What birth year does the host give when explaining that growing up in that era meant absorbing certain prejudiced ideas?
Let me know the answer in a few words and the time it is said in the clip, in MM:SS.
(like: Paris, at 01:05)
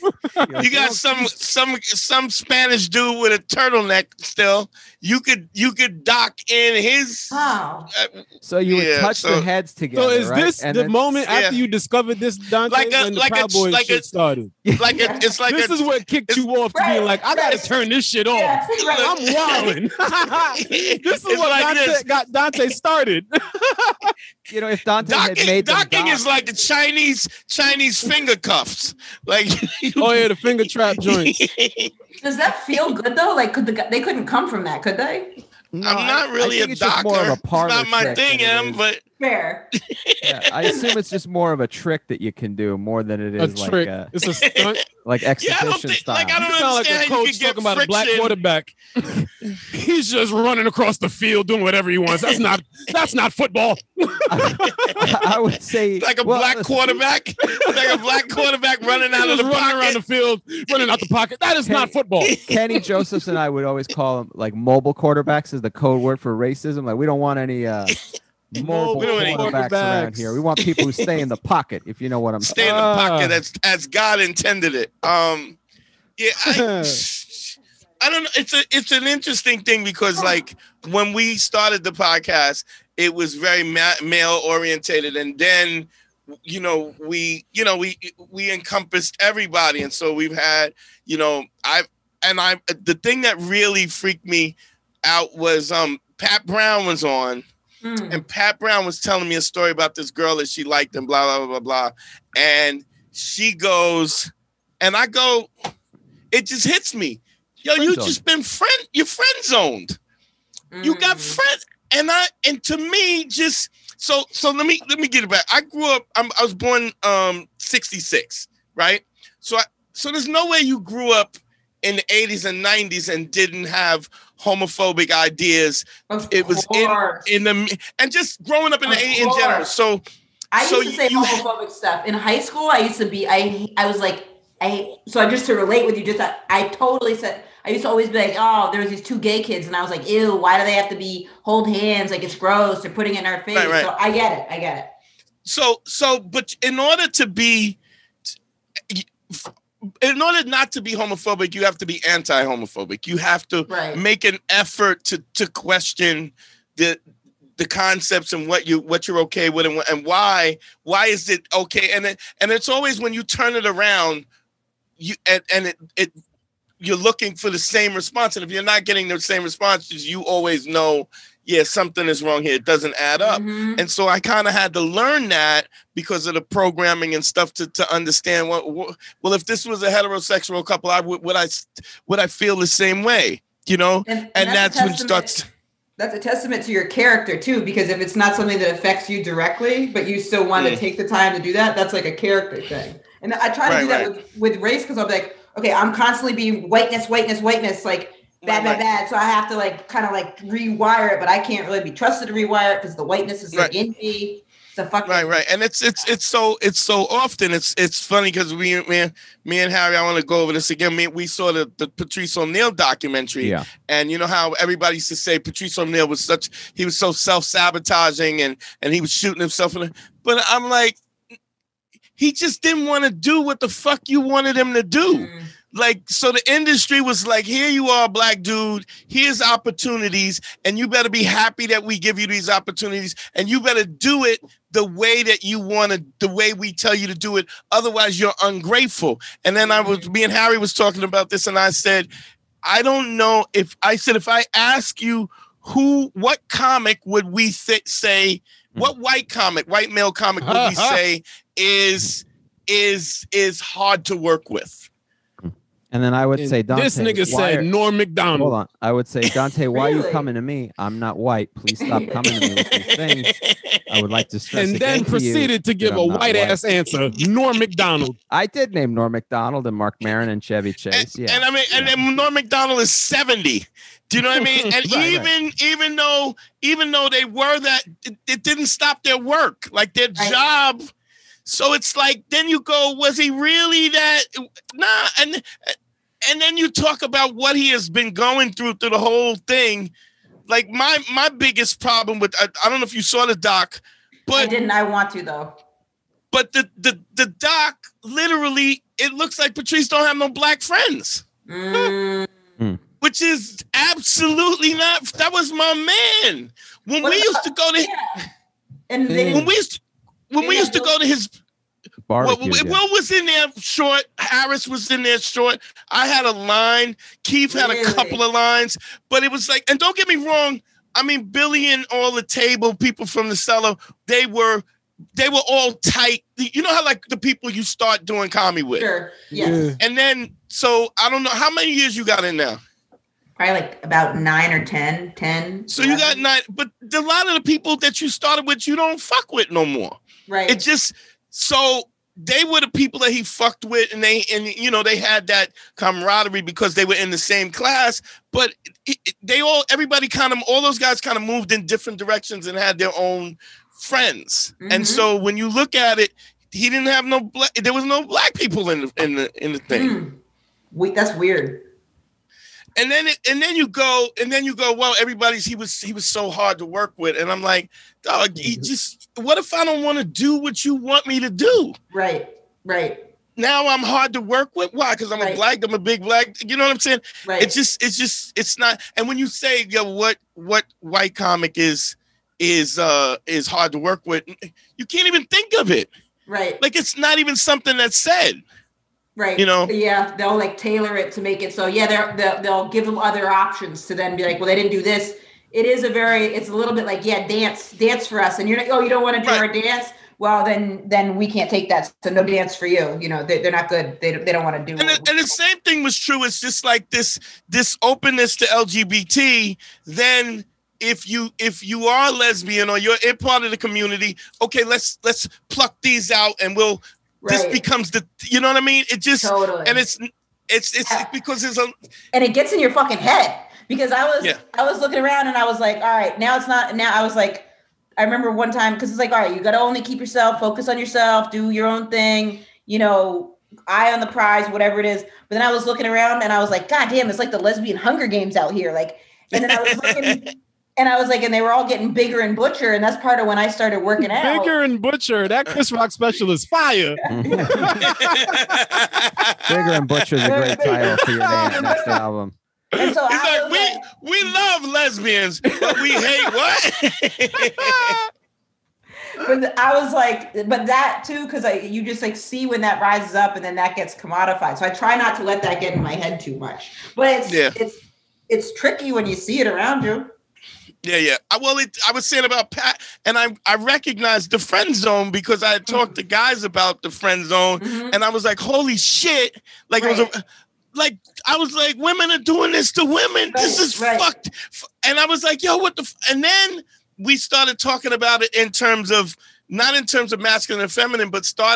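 1966, at 01:57.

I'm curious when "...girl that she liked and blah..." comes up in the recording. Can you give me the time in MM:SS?
01:40.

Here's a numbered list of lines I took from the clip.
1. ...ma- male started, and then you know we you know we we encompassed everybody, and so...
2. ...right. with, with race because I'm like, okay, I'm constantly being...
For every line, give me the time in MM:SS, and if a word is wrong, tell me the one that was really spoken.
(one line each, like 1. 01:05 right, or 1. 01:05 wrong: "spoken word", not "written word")
1. 01:23 wrong: "orientated", not "started"
2. 03:14 right.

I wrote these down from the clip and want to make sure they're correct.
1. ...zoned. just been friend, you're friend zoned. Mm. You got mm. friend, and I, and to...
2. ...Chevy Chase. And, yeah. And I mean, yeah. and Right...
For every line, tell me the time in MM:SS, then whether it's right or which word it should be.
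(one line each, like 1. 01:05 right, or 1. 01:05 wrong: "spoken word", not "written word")
1. 01:47 right
2. 04:30 wrong: "Norm", not "Right".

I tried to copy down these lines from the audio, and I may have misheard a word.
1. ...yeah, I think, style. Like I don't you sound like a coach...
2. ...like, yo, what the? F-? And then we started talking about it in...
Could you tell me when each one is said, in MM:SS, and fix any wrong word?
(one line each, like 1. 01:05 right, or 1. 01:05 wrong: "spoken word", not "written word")
1. 00:45 right
2. 08:05 right.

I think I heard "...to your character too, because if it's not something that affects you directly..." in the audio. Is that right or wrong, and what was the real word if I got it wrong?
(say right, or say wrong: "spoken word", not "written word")
right.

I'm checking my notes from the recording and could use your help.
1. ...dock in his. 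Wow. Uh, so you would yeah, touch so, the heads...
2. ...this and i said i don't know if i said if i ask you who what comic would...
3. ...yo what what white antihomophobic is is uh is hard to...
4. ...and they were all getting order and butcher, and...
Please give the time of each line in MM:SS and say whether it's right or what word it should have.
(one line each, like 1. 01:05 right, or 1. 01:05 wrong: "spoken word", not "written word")
1. 00:06 right
2. 04:01 right
3. 06:19 wrong: "comic", not "antihomophobic"
4. 07:21 wrong: "bigger", not "order".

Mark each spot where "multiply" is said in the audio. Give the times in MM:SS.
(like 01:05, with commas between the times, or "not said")
not said.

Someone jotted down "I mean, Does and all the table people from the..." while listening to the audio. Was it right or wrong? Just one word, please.
wrong.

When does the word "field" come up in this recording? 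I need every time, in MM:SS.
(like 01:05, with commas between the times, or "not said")
00:51, 01:00.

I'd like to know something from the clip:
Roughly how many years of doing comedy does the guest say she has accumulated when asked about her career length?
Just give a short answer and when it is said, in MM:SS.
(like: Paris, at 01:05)
11, at 05:35.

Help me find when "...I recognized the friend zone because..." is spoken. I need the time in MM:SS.
07:53.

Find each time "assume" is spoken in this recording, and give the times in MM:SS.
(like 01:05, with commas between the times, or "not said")
00:40.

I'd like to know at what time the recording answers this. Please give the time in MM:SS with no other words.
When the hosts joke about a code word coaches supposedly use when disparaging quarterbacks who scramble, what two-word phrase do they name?
01:04.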